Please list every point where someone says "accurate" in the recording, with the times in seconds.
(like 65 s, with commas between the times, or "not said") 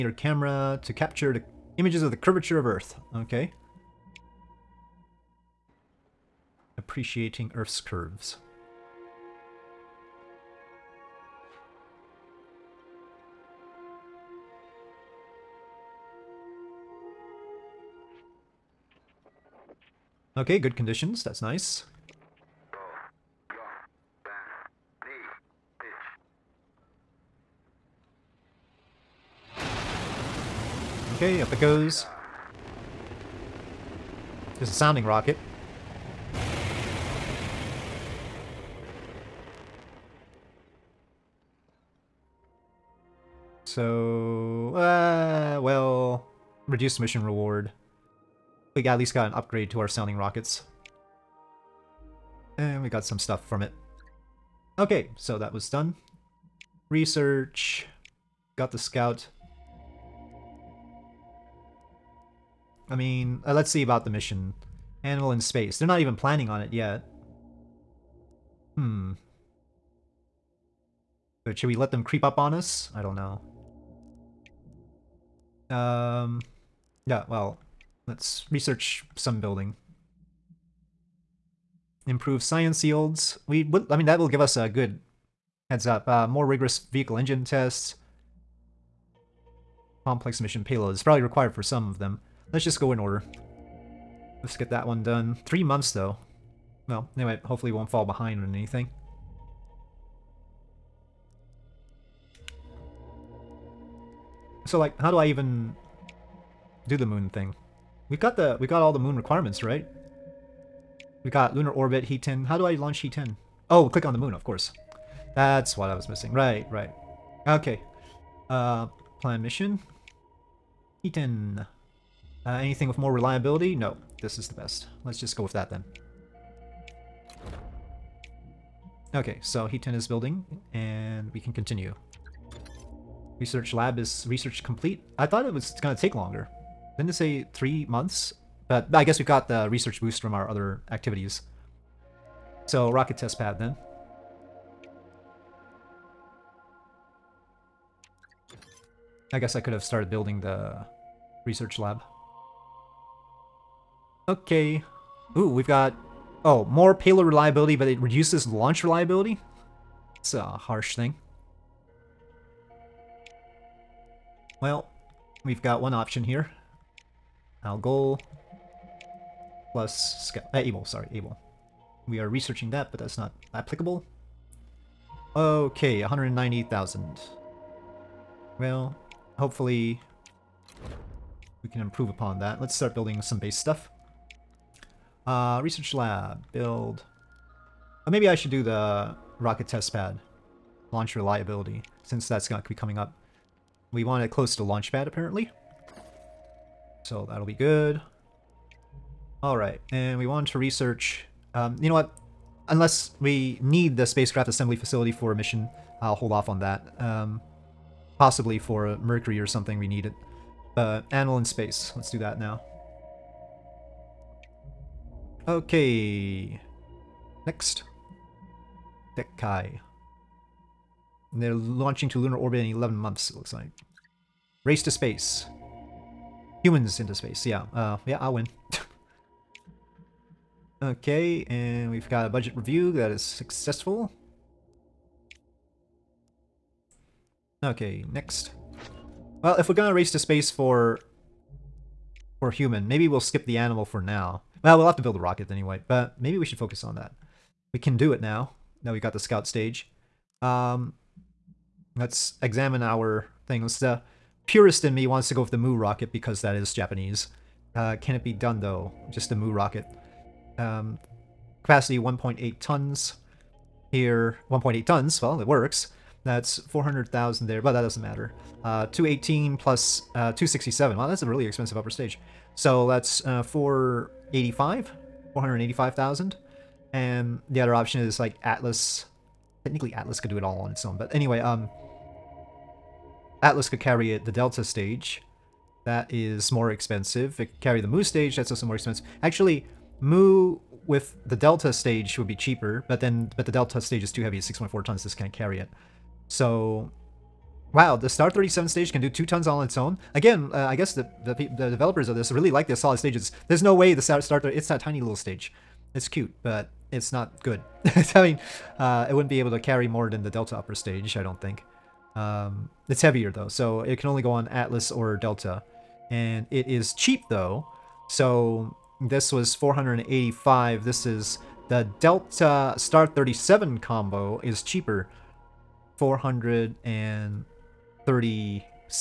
not said.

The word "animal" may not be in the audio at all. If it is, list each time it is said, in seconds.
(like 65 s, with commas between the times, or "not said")
65 s, 211 s, 243 s.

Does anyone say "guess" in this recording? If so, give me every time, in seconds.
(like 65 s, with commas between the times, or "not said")
139 s, 149 s, 300 s.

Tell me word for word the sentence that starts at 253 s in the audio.
the uh, purist in me wants to go with the Mu rocket because that is Japanese.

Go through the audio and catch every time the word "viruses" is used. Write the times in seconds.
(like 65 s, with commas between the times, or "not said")
not said.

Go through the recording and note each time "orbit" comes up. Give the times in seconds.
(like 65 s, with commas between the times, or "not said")
111 s, 222 s.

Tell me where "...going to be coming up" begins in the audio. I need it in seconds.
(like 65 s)
192 s.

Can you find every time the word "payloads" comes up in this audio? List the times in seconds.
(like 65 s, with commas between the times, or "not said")
90 s, 156 s.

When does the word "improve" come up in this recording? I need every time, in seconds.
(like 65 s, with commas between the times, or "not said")
82 s, 181 s.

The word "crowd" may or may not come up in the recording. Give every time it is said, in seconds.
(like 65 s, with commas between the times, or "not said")
not said.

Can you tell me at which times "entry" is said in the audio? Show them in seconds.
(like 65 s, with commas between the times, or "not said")
not said.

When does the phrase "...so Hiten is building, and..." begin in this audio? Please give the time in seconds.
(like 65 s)
129 s.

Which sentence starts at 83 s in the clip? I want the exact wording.
We would, I mean, that will give us a good heads up.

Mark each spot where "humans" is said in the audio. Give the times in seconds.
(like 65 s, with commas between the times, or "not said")
226 s, 242 s.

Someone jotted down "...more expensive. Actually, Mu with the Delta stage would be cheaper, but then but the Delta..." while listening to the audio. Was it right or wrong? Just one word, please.
right.